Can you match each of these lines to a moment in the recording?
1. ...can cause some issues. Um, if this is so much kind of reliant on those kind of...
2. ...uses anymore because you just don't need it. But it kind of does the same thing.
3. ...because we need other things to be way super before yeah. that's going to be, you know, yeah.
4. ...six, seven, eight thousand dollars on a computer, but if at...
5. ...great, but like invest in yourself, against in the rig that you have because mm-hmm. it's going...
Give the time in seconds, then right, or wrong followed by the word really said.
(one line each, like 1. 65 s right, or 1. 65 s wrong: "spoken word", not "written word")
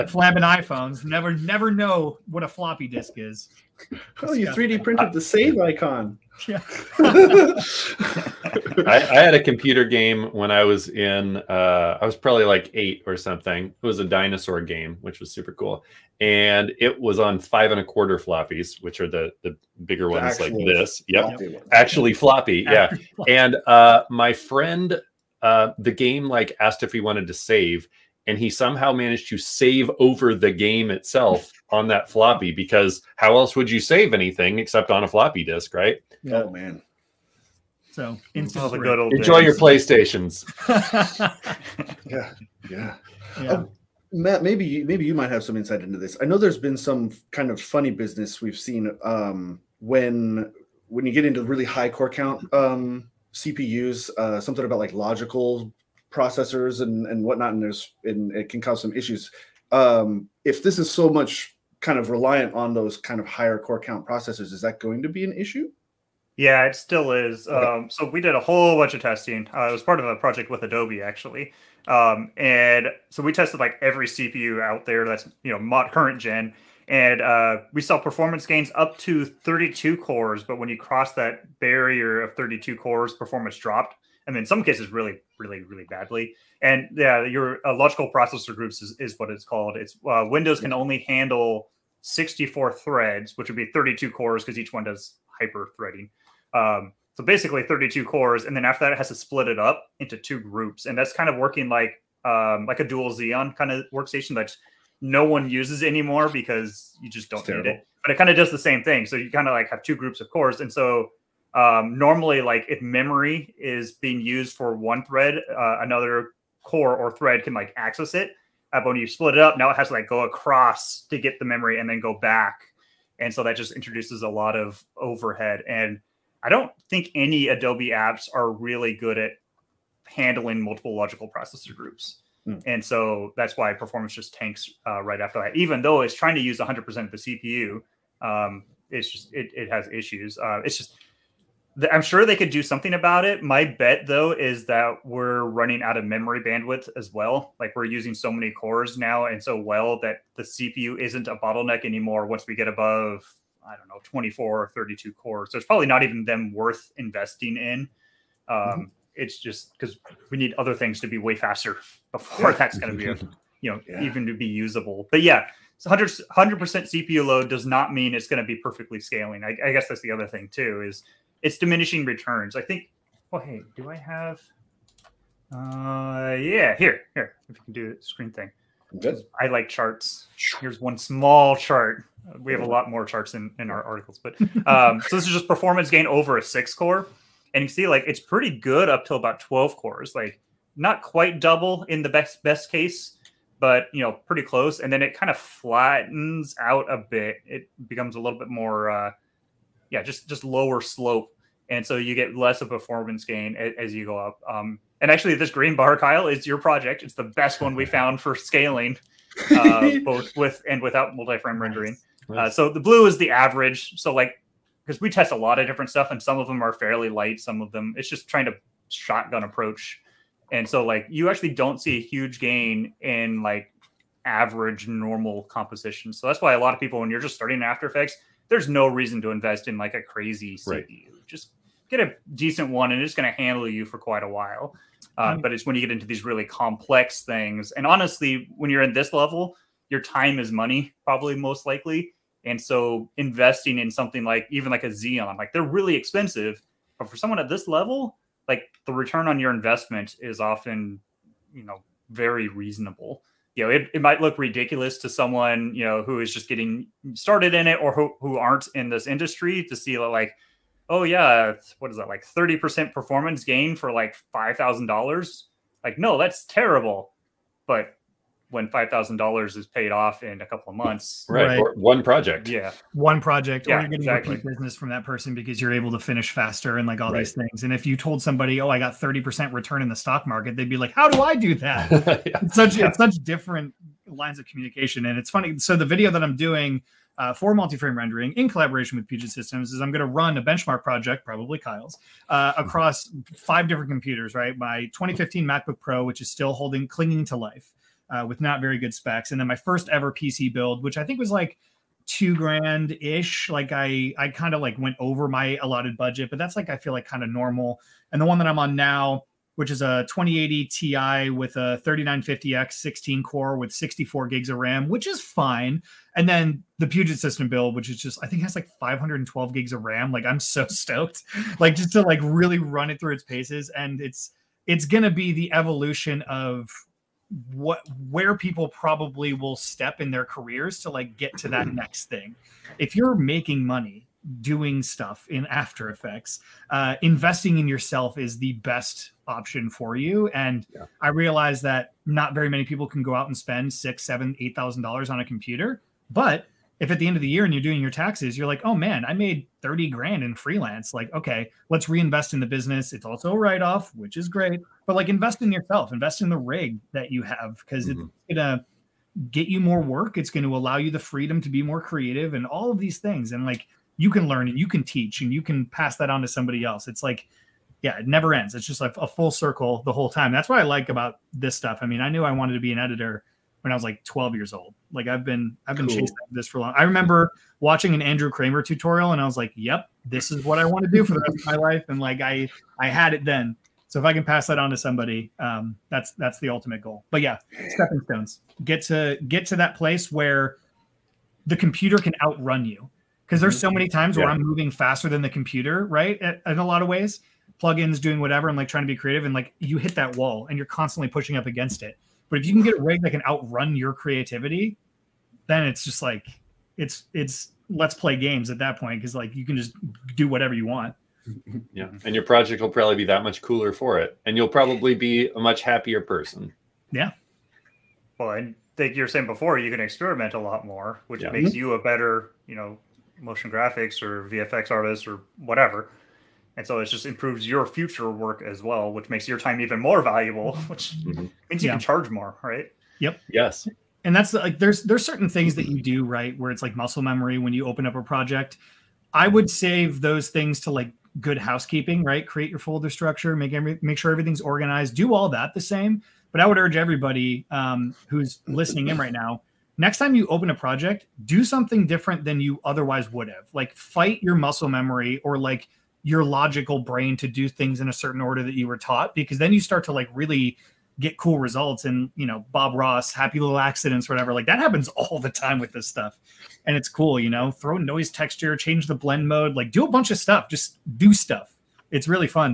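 1. 58 s right
2. 105 s right
3. 159 s wrong: "faster", not "super"
4. 343 s right
5. 354 s wrong: "invest", not "against".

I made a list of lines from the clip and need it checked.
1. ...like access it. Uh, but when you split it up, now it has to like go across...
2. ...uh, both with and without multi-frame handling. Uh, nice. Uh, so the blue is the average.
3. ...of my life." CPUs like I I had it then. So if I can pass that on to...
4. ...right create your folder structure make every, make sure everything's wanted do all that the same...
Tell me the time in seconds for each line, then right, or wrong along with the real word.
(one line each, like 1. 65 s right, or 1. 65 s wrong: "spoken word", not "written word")
1. 117 s right
2. 209 s wrong: "rendering", not "handling"
3. 381 s wrong: "And", not "CPUs"
4. 442 s wrong: "organized", not "wanted".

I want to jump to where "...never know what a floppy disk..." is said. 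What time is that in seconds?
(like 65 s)
1 s.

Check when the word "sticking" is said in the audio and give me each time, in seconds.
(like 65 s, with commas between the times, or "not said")
not said.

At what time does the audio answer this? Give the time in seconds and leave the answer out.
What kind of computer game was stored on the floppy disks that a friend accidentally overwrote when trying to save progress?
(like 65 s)
14 s.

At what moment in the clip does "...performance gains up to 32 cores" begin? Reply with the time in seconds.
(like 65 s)
77 s.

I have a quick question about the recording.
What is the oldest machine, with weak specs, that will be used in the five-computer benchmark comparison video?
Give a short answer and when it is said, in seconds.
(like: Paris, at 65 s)
2015 MacBook Pro, at 294 s.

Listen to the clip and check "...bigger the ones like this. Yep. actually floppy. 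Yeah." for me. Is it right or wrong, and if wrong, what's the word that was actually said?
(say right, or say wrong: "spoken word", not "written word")
right.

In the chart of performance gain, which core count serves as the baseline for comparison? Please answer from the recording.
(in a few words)
6.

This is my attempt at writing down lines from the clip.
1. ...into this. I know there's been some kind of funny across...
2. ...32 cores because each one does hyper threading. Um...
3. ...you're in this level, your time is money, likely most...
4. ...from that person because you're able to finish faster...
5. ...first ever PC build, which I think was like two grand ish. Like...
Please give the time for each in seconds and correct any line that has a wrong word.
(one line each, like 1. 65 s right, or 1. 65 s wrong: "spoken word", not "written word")
1. 45 s wrong: "business", not "across"
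2. 93 s right
3. 238 s wrong: "probably", not "likely"
4. 274 s right
5. 299 s right.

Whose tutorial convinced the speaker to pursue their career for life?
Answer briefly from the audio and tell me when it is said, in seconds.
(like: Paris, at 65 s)
Andrew Kramer, at 378 s.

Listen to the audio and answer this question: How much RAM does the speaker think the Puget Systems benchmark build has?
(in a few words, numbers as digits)
512 GB.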